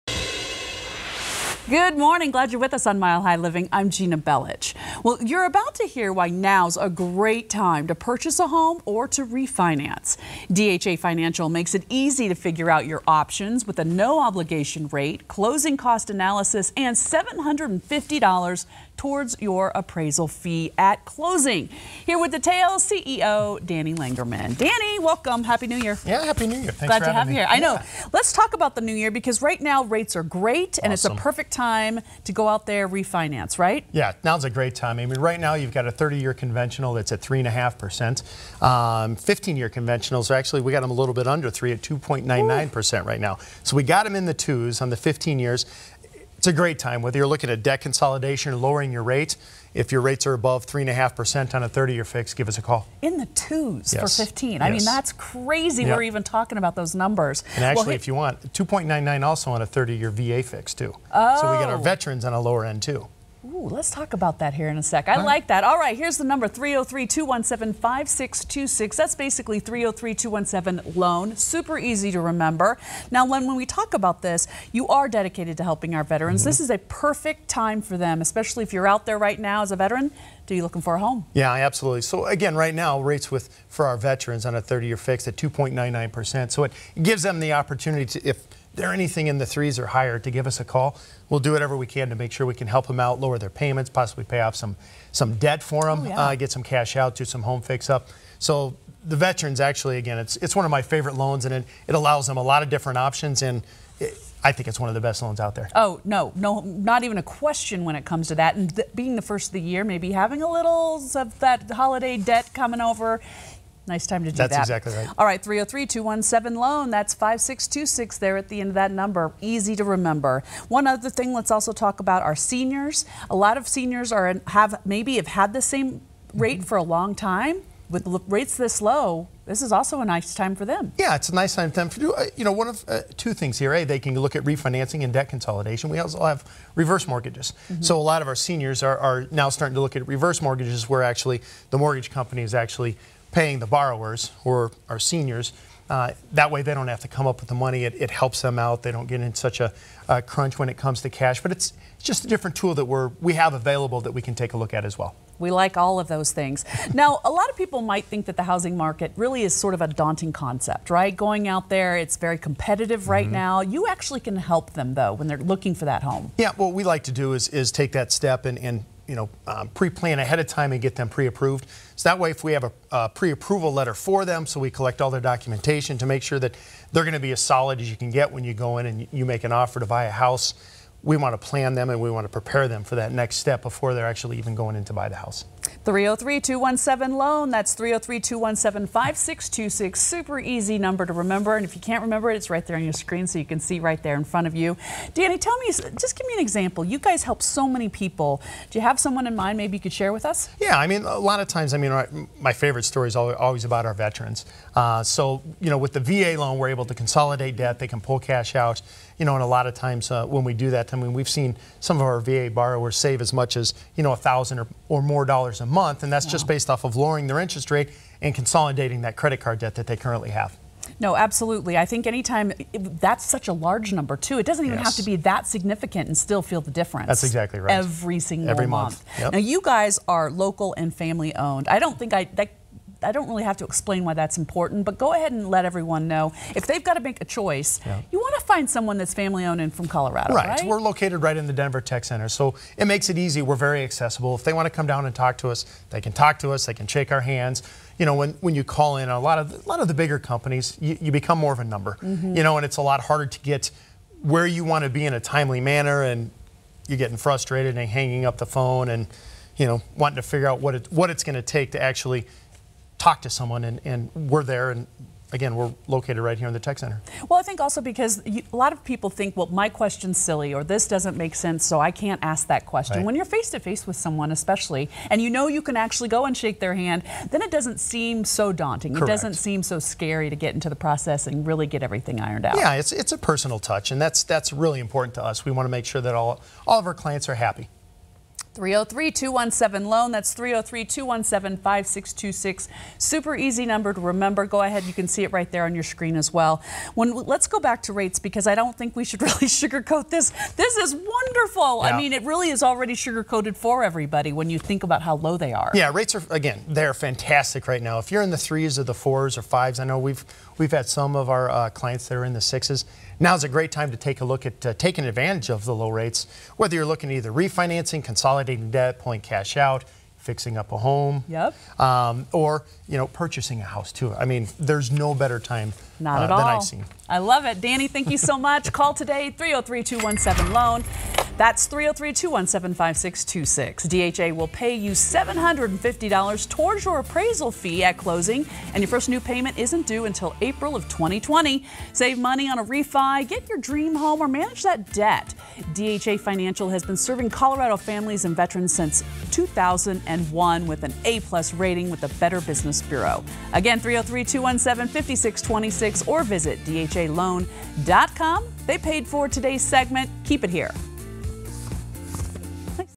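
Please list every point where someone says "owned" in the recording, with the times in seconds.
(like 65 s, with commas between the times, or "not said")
231 s, 239 s.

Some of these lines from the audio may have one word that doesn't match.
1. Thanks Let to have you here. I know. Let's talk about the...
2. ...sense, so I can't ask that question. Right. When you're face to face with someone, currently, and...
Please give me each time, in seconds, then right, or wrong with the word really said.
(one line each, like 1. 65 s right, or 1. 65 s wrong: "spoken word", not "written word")
1. 26 s wrong: "Glad", not "Let"
2. 271 s wrong: "especially", not "currently".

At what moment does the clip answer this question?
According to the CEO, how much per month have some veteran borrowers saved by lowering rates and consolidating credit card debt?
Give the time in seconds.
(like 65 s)
214 s.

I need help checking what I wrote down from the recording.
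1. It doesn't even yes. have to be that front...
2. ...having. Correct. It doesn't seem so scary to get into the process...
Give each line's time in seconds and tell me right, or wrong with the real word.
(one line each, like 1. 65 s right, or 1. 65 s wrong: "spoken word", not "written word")
1. 224 s wrong: "significant", not "front"
2. 278 s wrong: "daunting", not "having".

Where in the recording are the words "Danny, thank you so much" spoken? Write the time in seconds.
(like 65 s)
327 s.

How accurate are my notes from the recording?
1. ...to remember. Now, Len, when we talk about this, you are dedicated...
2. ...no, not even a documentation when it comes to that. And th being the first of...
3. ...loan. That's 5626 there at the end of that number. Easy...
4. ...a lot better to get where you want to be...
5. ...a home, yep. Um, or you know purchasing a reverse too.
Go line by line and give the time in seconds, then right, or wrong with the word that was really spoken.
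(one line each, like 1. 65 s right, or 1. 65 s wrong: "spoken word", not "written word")
1. 72 s right
2. 106 s wrong: "question", not "documentation"
3. 116 s right
4. 252 s wrong: "harder", not "better"
5. 320 s wrong: "house", not "reverse".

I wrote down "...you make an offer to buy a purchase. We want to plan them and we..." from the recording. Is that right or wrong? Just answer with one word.
wrong.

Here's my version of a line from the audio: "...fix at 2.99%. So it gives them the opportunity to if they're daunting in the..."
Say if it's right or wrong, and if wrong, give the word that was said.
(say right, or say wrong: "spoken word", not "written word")
wrong: "anything", not "daunting".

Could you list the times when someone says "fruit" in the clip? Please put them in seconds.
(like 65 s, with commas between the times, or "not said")
not said.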